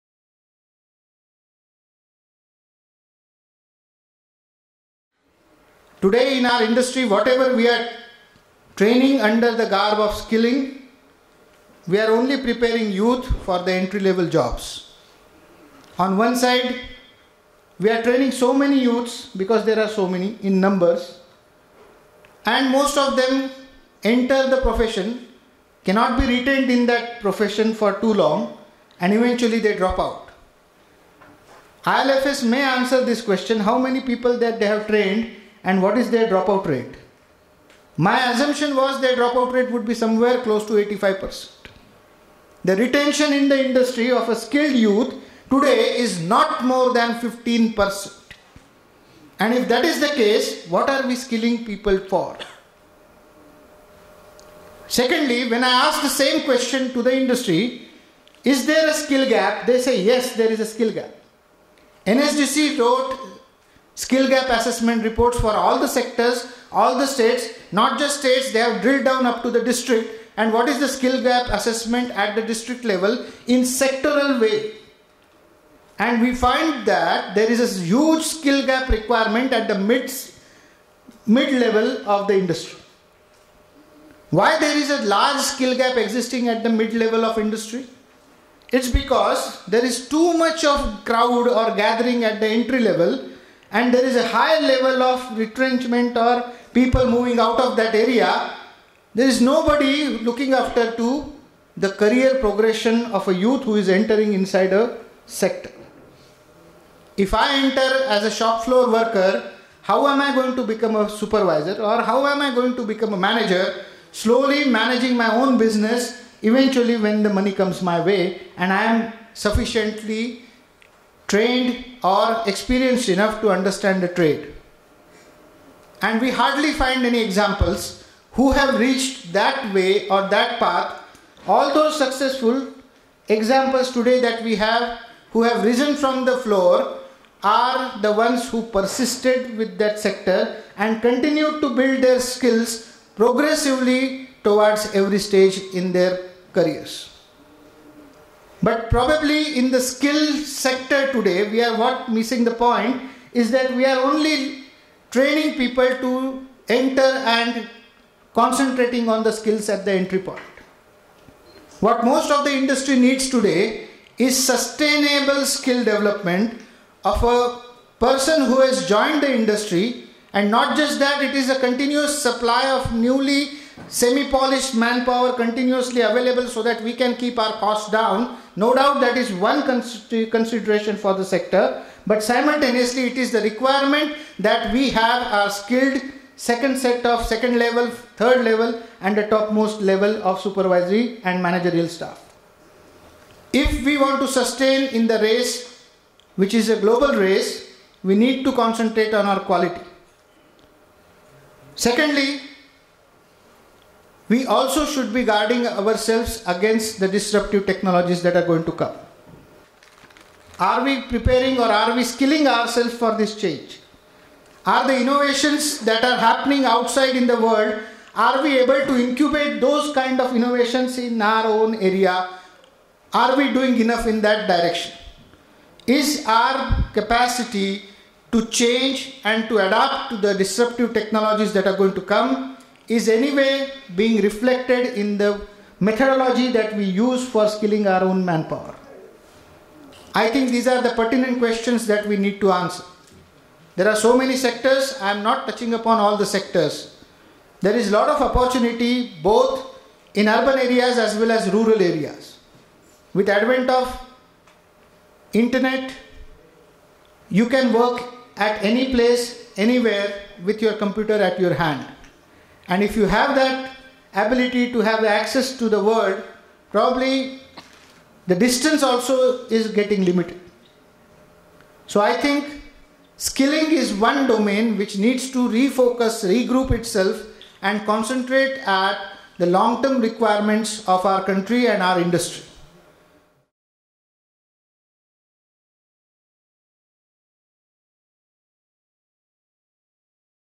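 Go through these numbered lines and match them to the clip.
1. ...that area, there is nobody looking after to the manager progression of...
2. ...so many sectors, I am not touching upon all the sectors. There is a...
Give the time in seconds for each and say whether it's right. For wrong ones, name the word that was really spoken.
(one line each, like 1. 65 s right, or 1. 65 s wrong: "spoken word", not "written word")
1. 97 s wrong: "career", not "manager"
2. 243 s right.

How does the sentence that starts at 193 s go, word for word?
If we want to sustain in the race, which is a global race, we need to concentrate on our quality.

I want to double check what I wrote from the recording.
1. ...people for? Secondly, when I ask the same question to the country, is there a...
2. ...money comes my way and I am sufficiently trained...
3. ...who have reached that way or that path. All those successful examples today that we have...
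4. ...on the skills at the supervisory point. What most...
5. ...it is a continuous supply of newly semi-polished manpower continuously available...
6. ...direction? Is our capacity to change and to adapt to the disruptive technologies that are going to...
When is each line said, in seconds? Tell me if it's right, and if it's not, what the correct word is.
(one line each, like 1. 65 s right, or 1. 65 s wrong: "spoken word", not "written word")
1. 51 s wrong: "industry", not "country"
2. 117 s right
3. 128 s right
4. 159 s wrong: "entry", not "supervisory"
5. 171 s right
6. 224 s right.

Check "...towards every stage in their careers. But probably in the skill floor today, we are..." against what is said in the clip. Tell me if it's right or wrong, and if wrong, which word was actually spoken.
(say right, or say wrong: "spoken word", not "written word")
wrong: "sector", not "floor".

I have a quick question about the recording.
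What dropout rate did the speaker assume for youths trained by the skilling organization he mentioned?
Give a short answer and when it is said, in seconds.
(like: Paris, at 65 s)
85%, at 40 s.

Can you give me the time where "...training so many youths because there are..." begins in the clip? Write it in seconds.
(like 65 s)
18 s.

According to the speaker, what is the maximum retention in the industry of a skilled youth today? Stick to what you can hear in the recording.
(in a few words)
15%.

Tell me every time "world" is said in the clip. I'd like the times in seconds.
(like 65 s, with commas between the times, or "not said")
217 s, 265 s.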